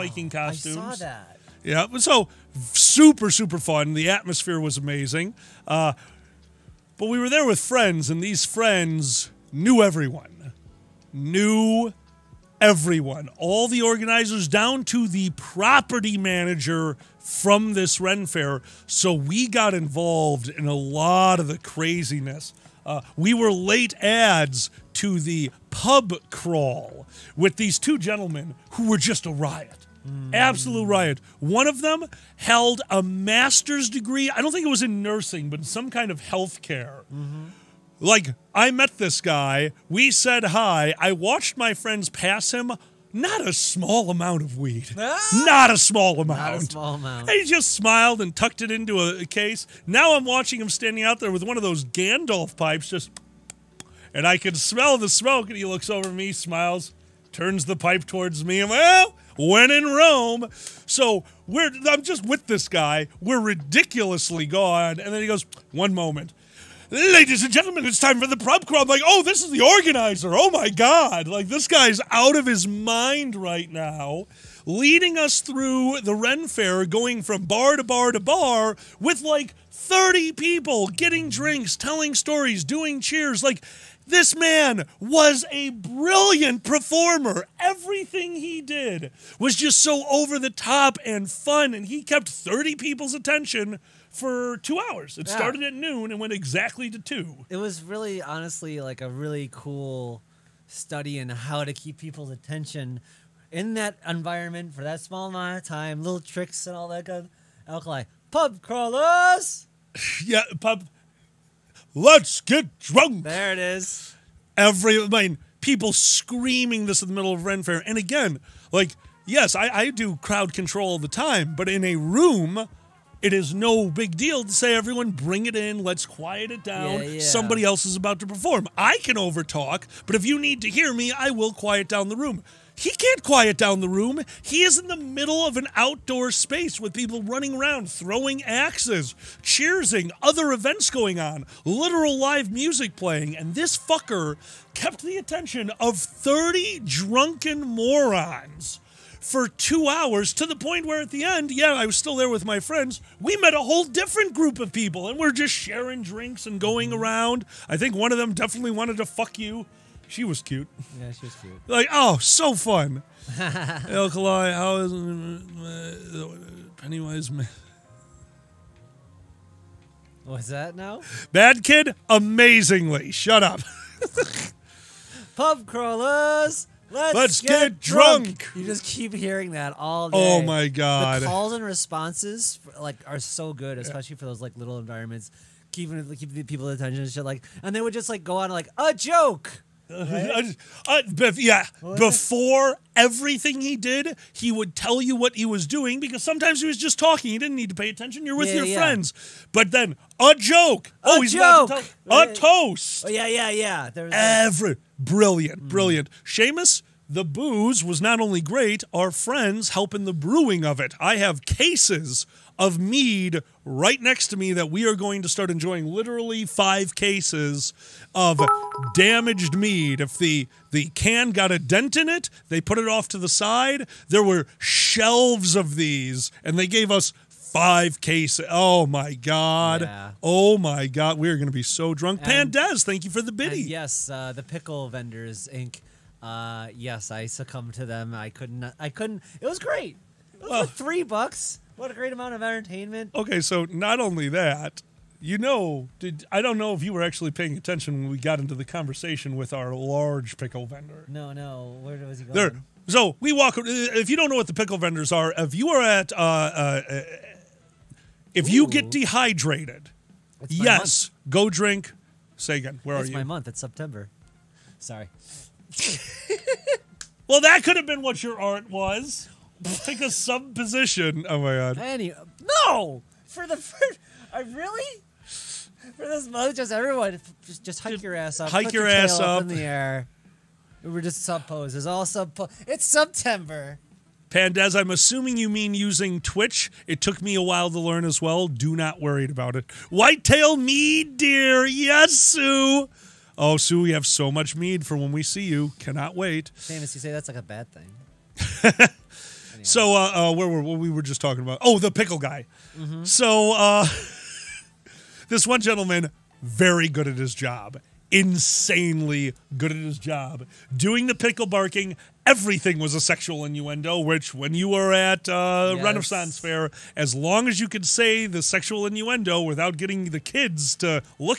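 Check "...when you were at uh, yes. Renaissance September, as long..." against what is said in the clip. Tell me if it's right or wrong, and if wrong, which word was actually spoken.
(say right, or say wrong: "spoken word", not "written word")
wrong: "Fair", not "September".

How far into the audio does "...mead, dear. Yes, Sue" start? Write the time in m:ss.
4:50.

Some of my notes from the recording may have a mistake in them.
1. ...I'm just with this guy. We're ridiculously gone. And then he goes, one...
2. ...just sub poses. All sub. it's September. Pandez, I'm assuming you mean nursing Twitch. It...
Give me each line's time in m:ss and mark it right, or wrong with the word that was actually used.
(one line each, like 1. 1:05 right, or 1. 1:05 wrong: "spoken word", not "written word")
1. 1:01 right
2. 4:41 wrong: "using", not "nursing".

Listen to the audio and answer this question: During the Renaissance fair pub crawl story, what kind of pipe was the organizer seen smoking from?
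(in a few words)
Gandalf pipes.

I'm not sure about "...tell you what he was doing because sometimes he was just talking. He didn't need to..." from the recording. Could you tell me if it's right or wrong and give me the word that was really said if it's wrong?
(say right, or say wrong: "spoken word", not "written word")
right.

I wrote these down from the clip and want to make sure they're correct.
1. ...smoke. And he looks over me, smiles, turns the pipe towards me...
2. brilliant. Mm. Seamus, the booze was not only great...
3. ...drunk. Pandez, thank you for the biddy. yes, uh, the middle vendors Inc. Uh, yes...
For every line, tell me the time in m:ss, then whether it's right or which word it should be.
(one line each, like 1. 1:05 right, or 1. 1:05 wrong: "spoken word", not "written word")
1. 0:55 right
2. 3:25 right
3. 3:51 wrong: "pickle", not "middle".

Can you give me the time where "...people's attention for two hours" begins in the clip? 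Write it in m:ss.
1:32.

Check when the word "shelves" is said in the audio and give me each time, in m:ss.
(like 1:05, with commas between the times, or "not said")
3:44.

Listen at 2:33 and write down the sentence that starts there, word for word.
We met a whole different group of people and we're just sharing drinks and going mm-hmm.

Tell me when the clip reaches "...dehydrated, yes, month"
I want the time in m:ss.
4:18.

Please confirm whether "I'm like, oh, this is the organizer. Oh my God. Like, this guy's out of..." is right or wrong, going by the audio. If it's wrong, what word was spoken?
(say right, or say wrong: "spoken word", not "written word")
right.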